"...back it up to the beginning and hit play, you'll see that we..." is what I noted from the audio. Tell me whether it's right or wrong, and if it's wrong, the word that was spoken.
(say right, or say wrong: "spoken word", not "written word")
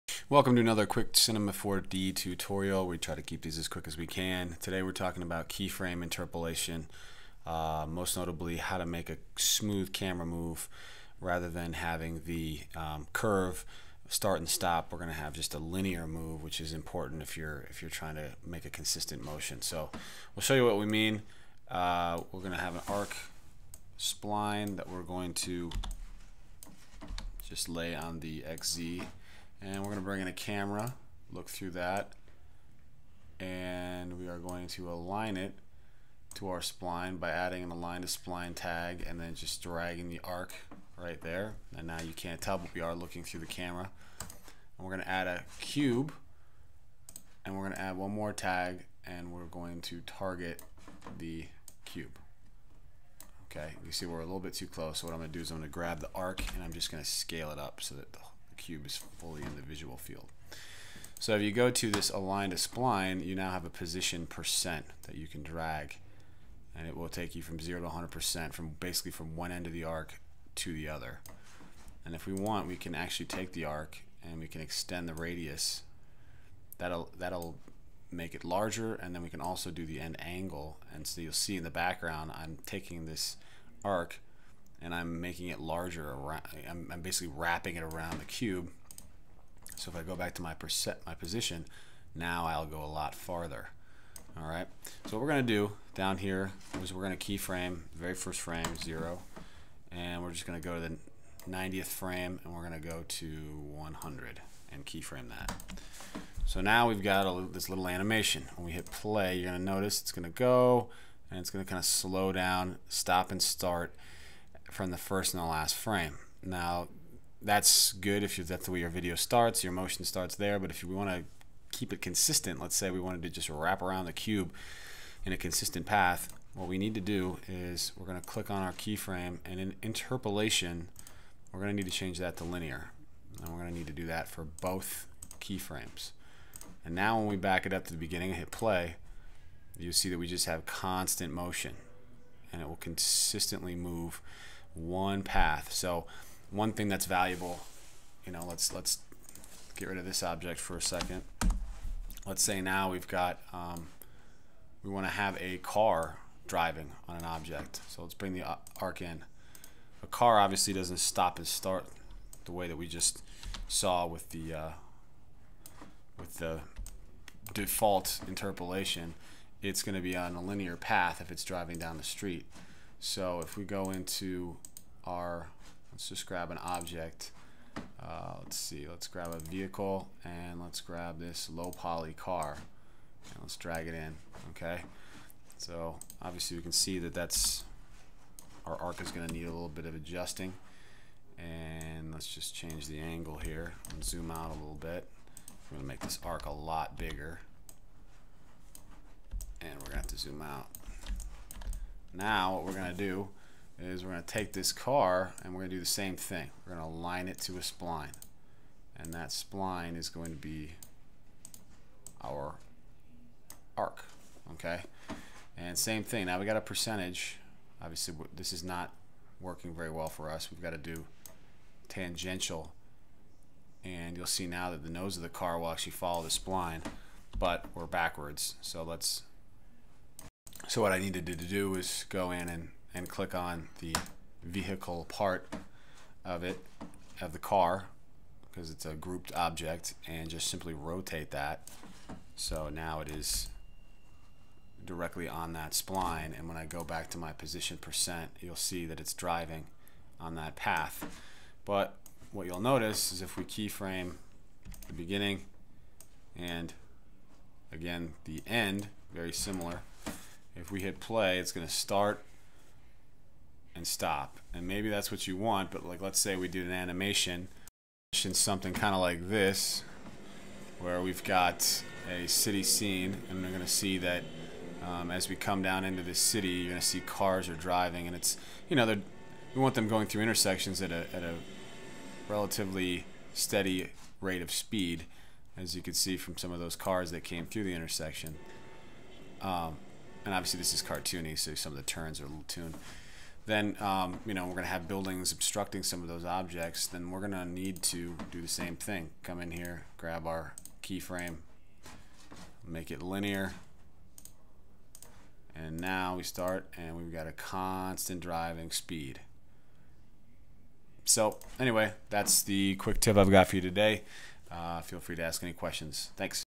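right.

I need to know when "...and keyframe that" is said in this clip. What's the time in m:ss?
1:44.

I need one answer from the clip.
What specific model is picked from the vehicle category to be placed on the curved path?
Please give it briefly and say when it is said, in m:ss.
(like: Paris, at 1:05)
low poly car, at 3:01.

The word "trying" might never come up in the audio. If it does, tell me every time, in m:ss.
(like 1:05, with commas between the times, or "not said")
0:17.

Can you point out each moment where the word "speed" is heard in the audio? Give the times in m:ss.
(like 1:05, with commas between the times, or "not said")
4:44, 5:08.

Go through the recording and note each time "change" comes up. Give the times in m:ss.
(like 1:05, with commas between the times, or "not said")
2:11, 3:12.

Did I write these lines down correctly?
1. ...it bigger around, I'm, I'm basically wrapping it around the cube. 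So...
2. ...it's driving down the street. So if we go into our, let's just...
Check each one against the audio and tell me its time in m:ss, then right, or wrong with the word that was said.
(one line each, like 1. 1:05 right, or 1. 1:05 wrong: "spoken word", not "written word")
1. 1:25 wrong: "larger", not "bigger"
2. 2:51 right.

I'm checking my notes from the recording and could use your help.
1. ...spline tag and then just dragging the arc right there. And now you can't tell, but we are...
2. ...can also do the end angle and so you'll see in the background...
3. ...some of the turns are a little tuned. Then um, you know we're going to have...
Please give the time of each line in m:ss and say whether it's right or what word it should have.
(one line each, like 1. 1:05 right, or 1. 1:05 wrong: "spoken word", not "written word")
1. 0:38 right
2. 1:19 right
3. 4:51 right.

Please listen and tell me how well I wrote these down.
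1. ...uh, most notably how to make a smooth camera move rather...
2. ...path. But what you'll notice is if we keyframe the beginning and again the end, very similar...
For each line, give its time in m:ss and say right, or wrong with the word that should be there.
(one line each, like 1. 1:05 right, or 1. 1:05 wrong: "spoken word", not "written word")
1. 0:07 right
2. 4:10 right.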